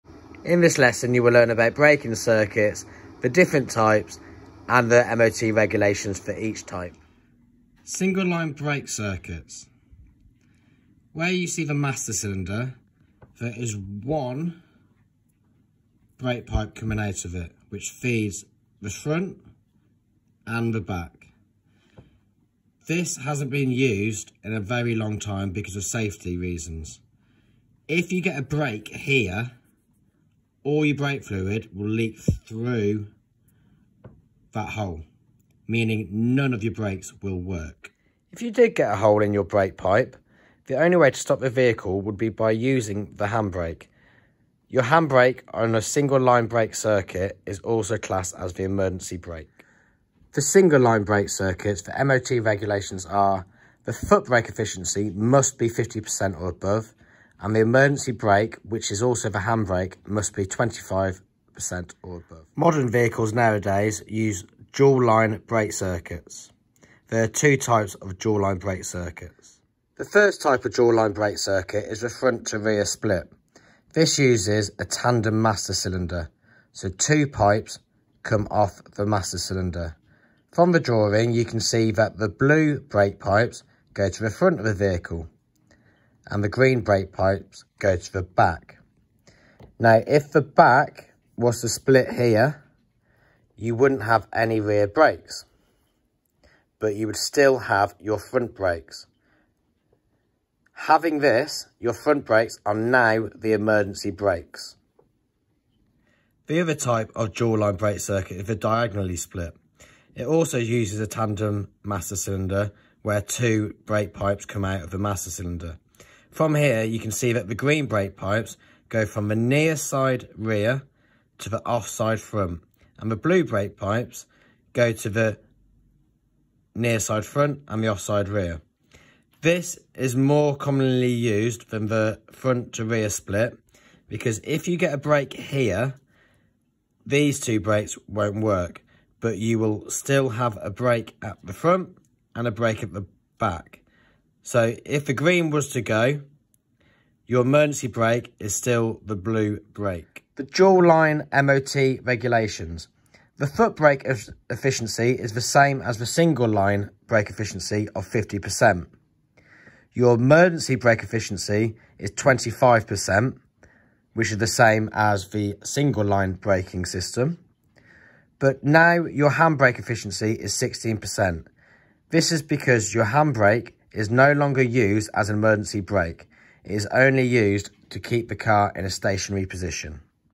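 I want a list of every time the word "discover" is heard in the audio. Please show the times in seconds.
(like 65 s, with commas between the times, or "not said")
not said.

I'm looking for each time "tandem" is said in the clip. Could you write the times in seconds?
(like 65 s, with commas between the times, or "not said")
74 s, 111 s.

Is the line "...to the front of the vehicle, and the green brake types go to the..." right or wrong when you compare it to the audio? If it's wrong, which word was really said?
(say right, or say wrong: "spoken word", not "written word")
wrong: "pipes", not "types".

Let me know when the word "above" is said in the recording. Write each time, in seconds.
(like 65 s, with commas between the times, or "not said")
56 s, 62 s.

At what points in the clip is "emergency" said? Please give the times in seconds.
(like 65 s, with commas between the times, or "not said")
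48 s, 57 s, 103 s, 147 s, 160 s, 175 s.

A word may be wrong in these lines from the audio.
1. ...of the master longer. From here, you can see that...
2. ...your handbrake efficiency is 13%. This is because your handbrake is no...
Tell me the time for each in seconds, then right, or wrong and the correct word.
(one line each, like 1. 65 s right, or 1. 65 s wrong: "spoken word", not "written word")
1. 114 s wrong: "cylinder", not "longer"
2. 169 s wrong: "16", not "13".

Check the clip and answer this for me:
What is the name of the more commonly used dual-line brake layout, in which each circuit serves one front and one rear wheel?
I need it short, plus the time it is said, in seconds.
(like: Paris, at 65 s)
Diagonally split, at 108 s.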